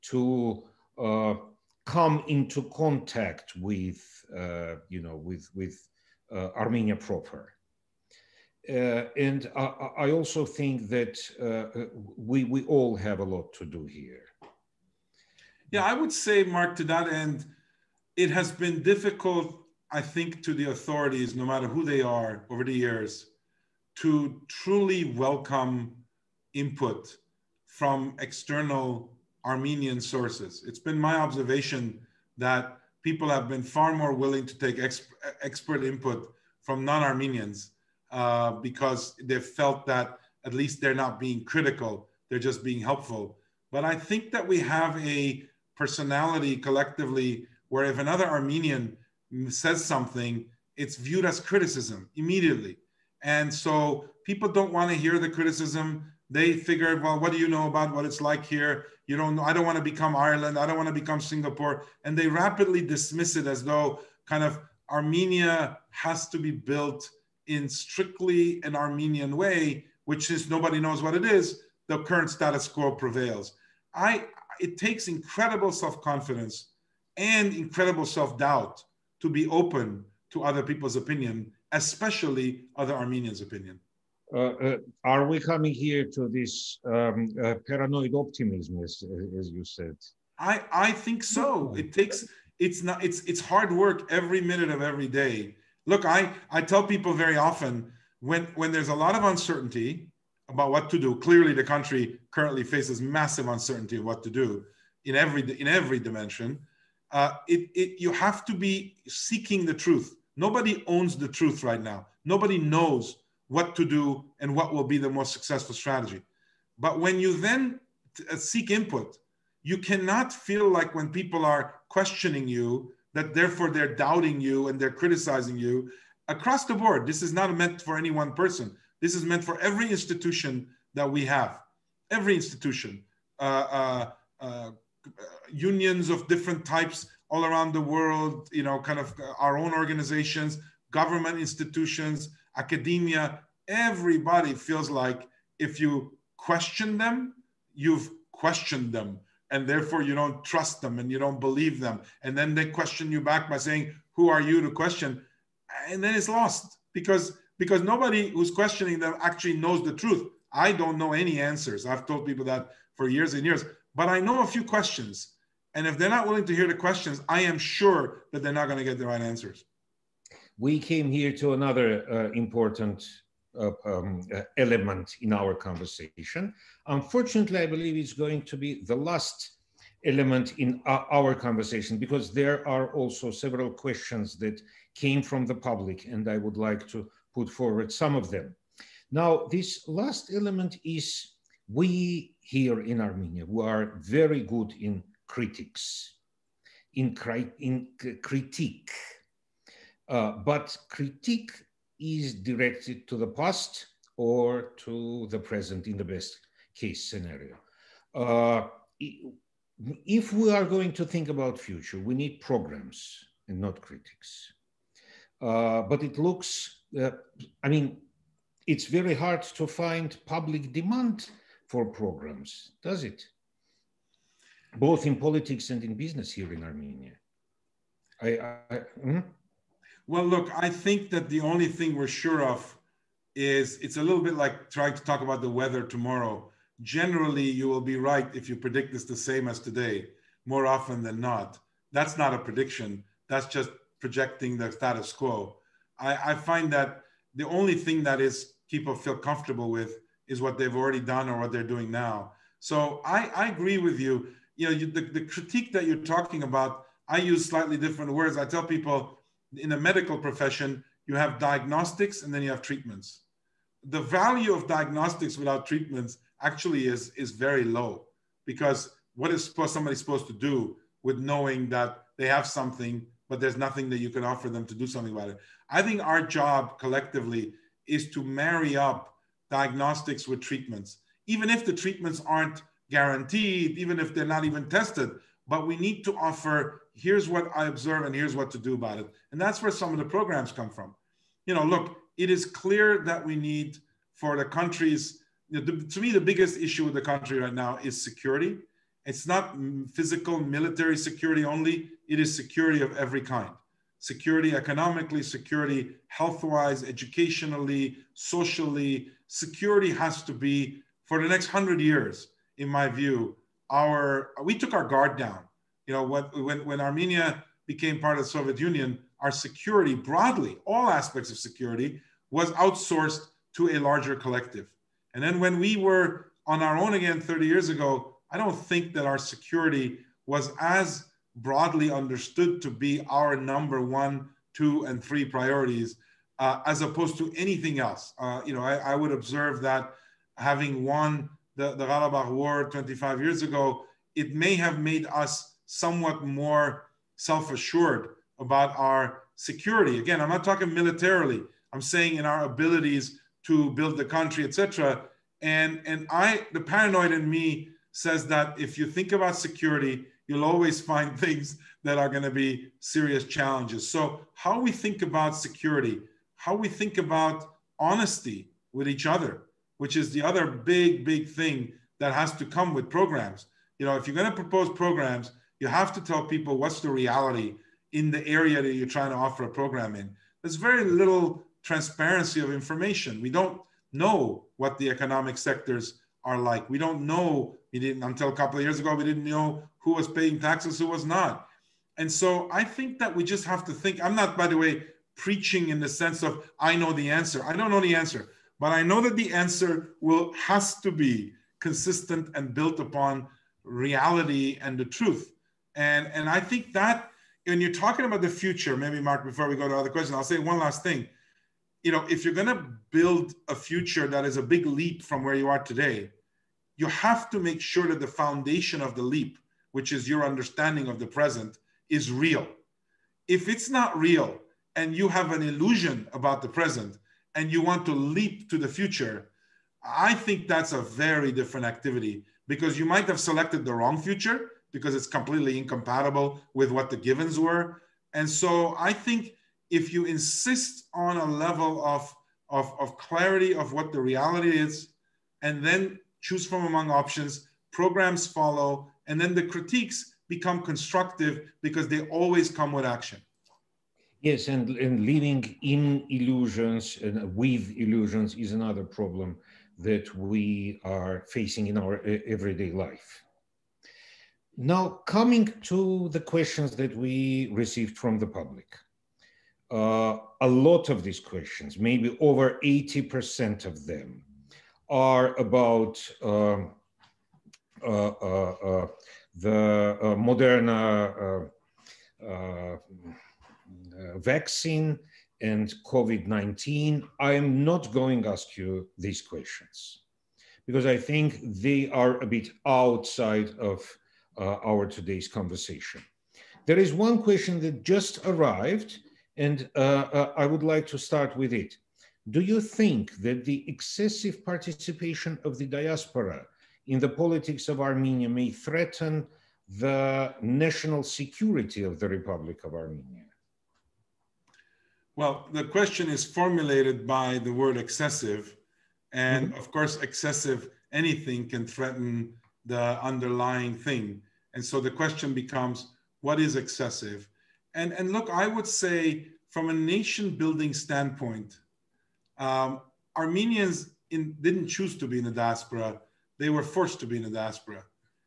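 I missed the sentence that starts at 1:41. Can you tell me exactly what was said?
Clearly, the country currently faces massive uncertainty of what to do in every in every dimension.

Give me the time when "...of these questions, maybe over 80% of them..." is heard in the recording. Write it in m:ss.
7:50.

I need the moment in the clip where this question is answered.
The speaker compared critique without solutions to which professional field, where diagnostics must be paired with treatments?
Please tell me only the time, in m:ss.
4:19.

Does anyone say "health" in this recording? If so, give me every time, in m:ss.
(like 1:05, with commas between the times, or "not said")
5:06.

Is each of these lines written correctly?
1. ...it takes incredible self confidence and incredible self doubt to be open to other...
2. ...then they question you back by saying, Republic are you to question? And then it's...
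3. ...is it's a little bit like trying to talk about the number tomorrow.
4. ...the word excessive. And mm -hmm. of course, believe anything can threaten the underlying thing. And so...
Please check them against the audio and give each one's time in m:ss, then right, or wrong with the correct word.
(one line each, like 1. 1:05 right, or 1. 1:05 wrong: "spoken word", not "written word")
1. 1:14 right
2. 2:32 wrong: "Who", not "Republic"
3. 3:53 wrong: "weather", not "number"
4. 8:37 wrong: "excessive", not "believe".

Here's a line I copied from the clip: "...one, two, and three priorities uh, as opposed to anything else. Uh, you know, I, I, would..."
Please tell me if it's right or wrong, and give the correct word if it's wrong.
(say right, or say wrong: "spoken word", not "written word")
right.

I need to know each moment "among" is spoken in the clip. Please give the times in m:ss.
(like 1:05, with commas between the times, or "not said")
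7:26.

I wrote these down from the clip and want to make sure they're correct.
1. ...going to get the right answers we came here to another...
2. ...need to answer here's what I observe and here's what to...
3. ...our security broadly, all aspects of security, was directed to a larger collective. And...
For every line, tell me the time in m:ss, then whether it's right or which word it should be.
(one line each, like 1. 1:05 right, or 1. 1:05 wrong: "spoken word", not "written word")
1. 2:48 right
2. 4:45 wrong: "offer", not "answer"
3. 5:19 wrong: "outsourced", not "directed".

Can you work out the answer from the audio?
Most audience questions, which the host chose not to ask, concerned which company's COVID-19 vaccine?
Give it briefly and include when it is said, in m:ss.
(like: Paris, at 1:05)
Moderna, at 8:00.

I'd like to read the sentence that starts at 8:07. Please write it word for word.
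I am not going to ask you these questions because I think they are a bit outside of uh, our today's conversation.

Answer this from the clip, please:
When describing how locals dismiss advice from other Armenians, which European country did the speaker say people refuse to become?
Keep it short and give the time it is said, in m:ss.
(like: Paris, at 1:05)
Ireland, at 1:00.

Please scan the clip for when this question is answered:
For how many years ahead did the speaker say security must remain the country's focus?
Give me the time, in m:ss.
5:11.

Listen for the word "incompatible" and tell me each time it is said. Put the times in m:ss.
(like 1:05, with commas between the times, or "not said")
7:15.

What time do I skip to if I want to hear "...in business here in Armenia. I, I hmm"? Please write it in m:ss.
3:45.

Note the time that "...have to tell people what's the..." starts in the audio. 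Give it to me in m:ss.
6:15.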